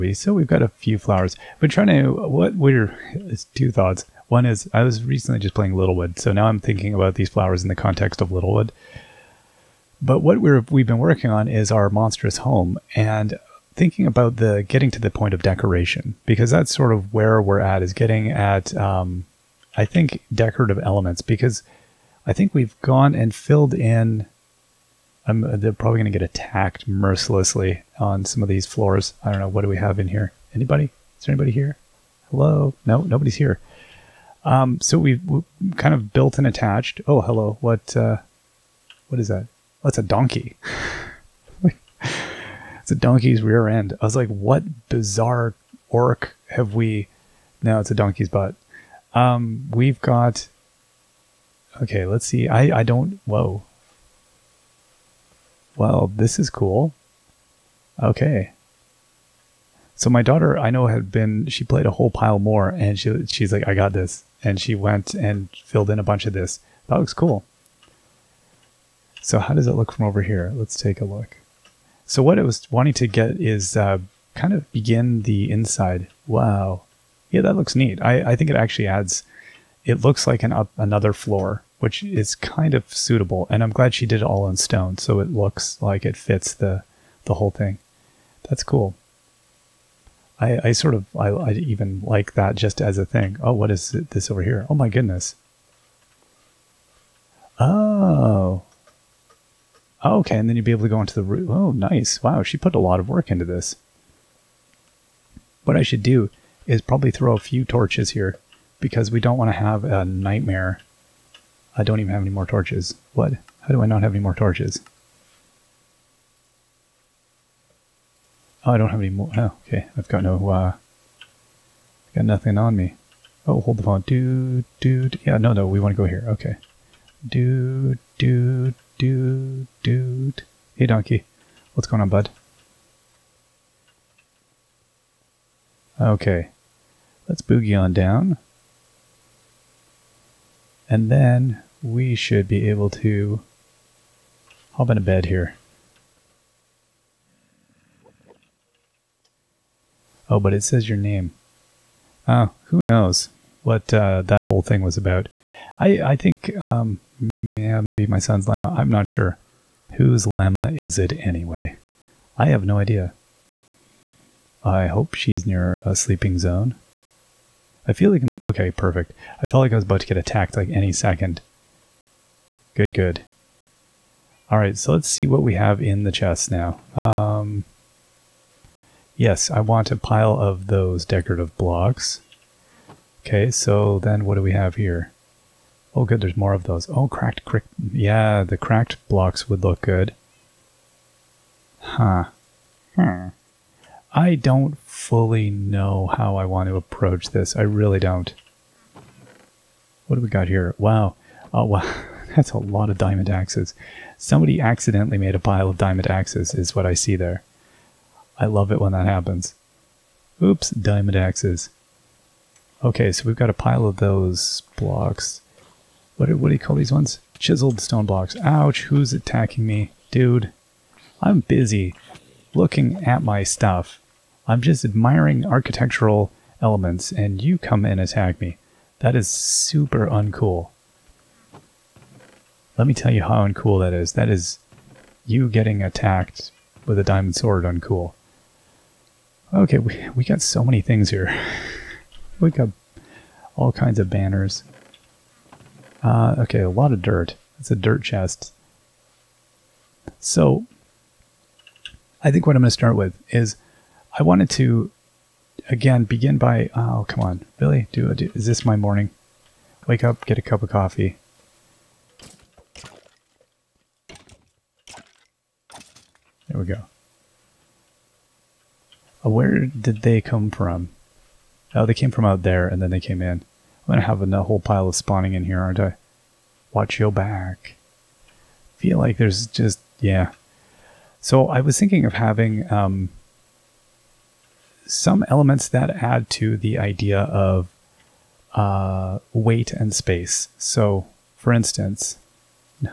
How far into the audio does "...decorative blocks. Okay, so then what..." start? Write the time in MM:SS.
03:01.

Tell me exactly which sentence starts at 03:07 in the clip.
Yeah, the cracked blocks would look good.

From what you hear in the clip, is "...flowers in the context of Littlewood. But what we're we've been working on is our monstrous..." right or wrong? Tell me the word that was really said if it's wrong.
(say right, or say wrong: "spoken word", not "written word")
right.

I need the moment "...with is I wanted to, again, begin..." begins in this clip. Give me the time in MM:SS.
04:12.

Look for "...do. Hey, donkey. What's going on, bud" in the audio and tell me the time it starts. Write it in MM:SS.
02:09.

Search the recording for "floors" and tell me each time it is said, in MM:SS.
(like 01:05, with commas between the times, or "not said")
00:28, 01:21.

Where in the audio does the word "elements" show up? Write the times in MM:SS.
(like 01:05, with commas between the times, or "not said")
00:20, 03:46, 04:45.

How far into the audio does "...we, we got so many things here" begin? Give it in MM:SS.
03:59.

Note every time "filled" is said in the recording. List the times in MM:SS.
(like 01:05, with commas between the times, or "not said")
00:23, 01:05.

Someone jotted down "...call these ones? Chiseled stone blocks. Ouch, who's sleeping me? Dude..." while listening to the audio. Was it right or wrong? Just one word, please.
wrong.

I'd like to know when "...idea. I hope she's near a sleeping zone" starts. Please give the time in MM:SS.
02:42.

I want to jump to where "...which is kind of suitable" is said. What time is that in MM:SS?
01:21.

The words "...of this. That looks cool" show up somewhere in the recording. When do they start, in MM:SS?
01:06.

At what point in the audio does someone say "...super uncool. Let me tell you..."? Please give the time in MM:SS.
03:49.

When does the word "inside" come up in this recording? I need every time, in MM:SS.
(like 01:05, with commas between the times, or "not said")
01:15.